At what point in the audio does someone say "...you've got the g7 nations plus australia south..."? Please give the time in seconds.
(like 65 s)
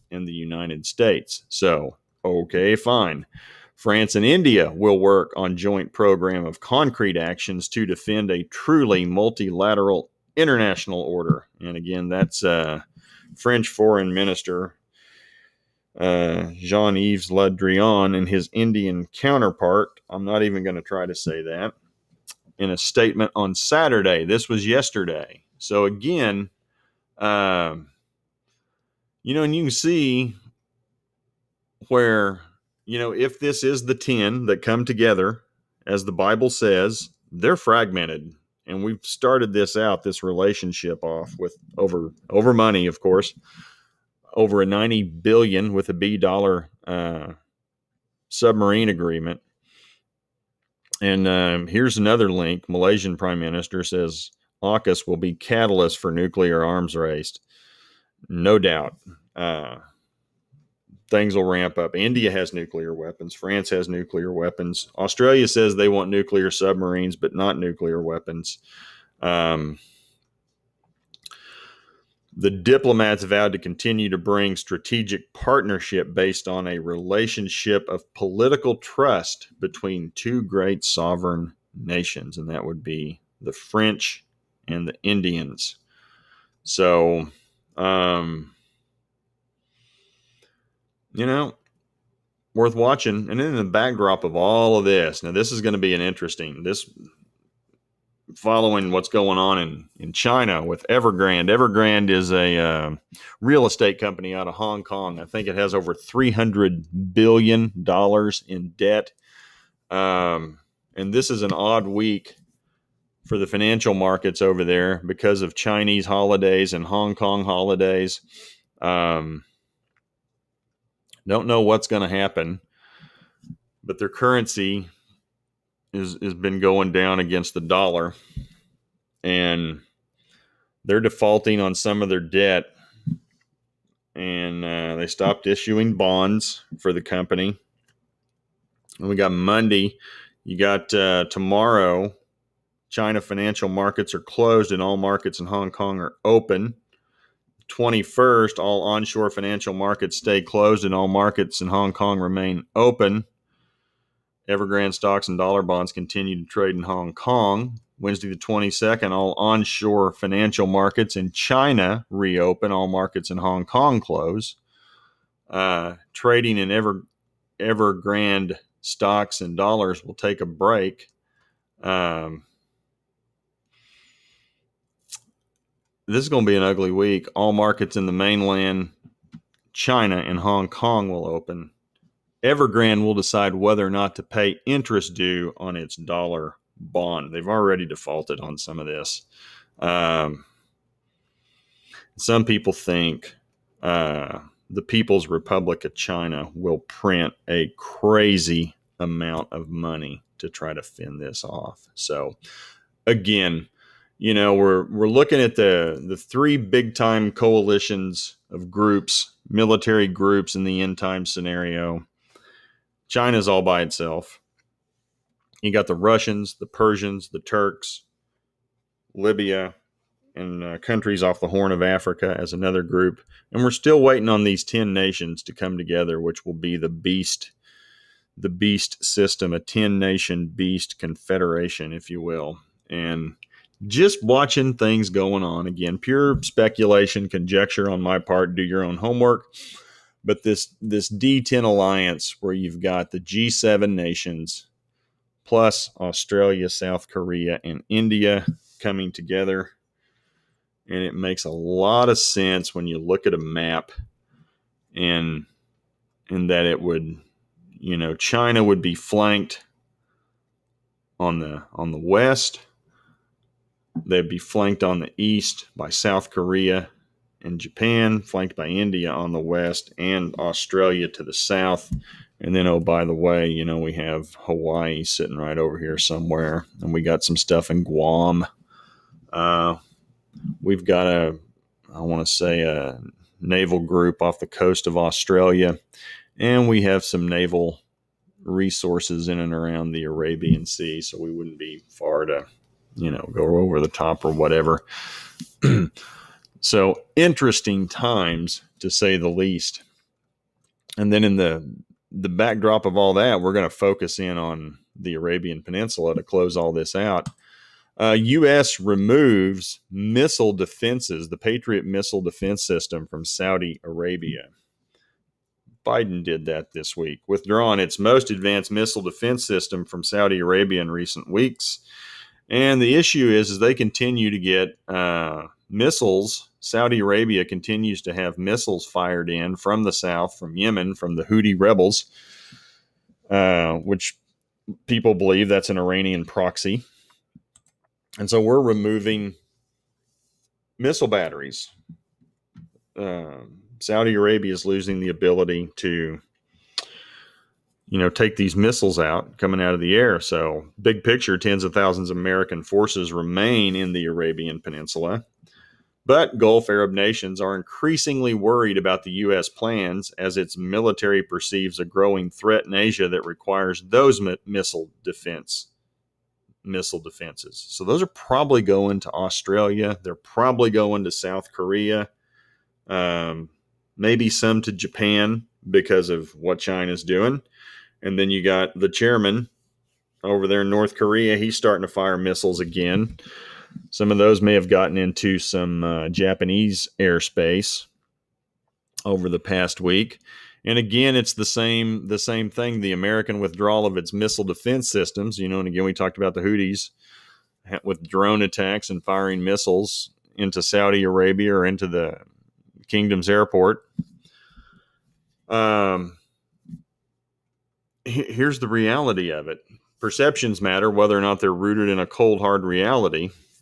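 242 s.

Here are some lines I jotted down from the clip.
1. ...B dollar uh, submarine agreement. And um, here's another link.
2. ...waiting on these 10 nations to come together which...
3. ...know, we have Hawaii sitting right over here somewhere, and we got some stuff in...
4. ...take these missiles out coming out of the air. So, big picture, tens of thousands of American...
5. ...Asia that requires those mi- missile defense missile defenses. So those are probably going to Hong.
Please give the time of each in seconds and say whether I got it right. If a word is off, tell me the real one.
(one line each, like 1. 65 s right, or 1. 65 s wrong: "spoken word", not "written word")
1. 45 s right
2. 224 s right
3. 273 s right
4. 348 s right
5. 362 s wrong: "Australia", not "Hong".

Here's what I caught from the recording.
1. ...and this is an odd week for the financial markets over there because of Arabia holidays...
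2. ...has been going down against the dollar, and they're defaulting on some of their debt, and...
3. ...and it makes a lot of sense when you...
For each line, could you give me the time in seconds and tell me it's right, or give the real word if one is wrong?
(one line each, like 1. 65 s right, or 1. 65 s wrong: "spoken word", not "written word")
1. 110 s wrong: "Chinese", not "Arabia"
2. 126 s right
3. 250 s right.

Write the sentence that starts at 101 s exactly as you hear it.
Evergrande is a uh, real estate company out of Hong Kong.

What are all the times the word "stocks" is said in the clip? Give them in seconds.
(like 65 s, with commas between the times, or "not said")
154 s, 168 s.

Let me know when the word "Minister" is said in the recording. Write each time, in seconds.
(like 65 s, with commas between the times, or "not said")
14 s, 53 s.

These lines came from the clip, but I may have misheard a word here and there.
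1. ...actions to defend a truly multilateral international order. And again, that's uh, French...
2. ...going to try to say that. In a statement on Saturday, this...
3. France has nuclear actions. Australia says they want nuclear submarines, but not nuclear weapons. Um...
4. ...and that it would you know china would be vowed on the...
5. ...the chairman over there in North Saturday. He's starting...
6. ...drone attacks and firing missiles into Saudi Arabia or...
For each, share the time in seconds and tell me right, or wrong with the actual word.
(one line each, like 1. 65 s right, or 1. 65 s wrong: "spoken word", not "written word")
1. 7 s right
2. 20 s right
3. 63 s wrong: "weapons", not "actions"
4. 256 s wrong: "flanked", not "vowed"
5. 378 s wrong: "Korea", not "Saturday"
6. 398 s right.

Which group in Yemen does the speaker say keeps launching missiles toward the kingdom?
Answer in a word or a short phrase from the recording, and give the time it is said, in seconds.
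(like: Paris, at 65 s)
Houthi rebels, at 331 s.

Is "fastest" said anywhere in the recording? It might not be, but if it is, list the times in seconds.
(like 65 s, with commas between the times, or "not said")
not said.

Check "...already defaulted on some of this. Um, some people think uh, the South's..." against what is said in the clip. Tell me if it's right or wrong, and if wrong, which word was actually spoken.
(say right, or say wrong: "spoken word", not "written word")
wrong: "People", not "South".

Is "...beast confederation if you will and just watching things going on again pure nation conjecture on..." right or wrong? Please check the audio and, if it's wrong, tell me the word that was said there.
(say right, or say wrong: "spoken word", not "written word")
wrong: "speculation", not "nation".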